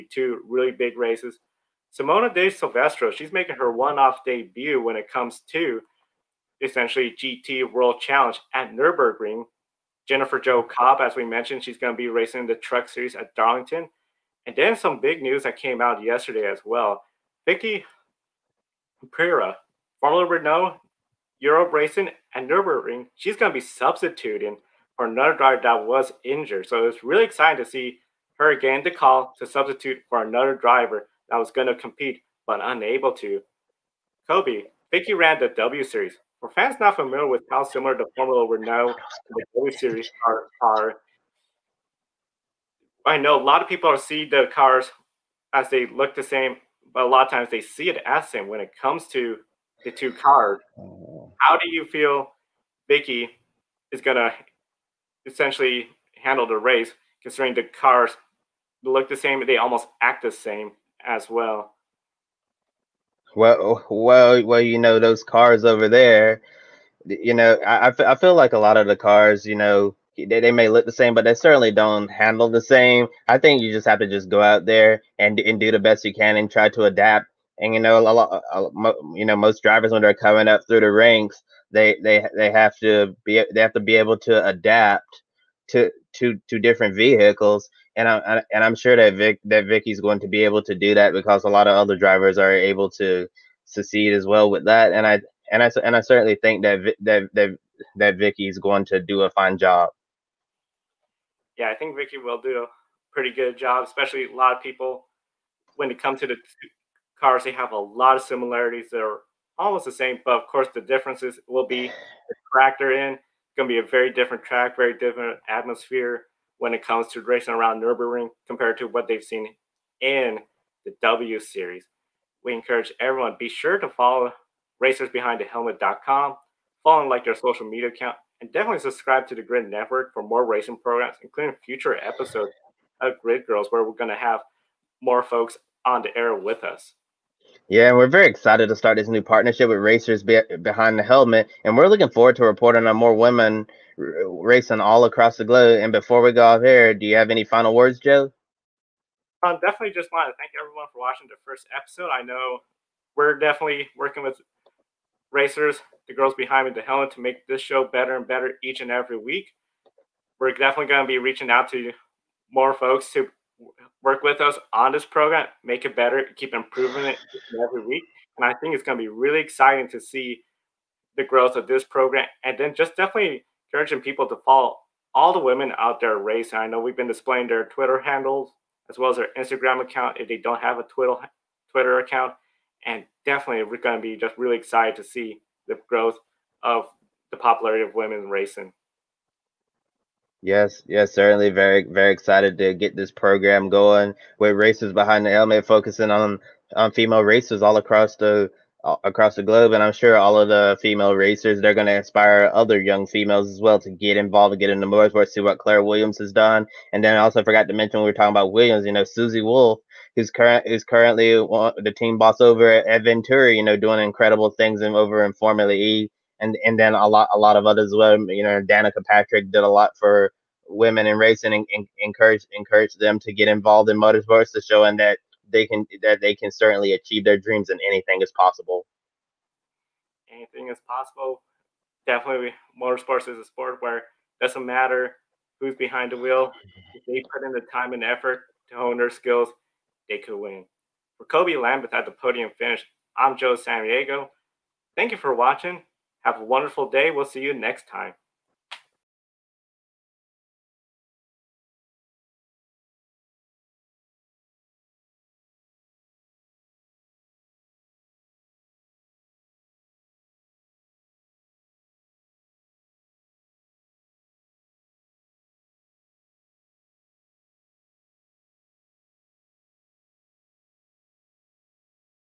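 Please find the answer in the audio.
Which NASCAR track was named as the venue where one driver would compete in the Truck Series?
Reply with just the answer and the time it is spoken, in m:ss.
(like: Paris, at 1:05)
Darlington, at 0:13.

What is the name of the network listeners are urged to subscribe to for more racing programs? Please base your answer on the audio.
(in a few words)
Grid Network.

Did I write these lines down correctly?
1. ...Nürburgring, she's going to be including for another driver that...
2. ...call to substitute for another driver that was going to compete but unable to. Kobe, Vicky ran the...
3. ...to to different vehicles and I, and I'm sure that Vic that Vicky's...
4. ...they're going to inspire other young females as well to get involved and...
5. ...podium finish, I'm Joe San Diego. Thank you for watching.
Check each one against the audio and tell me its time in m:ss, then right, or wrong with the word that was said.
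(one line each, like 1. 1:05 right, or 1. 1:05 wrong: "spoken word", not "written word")
1. 0:22 wrong: "substituting", not "including"
2. 0:28 right
3. 1:26 right
4. 3:21 right
5. 4:02 right.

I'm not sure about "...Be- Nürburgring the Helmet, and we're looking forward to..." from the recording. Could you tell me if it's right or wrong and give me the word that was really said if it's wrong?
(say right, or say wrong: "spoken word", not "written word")
wrong: "Behind", not "Nürburgring".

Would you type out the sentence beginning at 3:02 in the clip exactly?
And definitely, we're going to be just really excited to see the growth of the popularity of women racing.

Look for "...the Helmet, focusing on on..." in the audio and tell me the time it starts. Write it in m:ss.
3:15.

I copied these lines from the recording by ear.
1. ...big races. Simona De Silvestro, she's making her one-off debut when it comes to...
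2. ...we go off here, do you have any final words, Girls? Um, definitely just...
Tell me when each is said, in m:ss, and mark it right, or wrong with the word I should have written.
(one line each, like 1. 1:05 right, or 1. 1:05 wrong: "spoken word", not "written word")
1. 0:00 right
2. 2:26 wrong: "Joe", not "Girls".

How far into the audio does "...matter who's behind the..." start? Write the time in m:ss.
3:54.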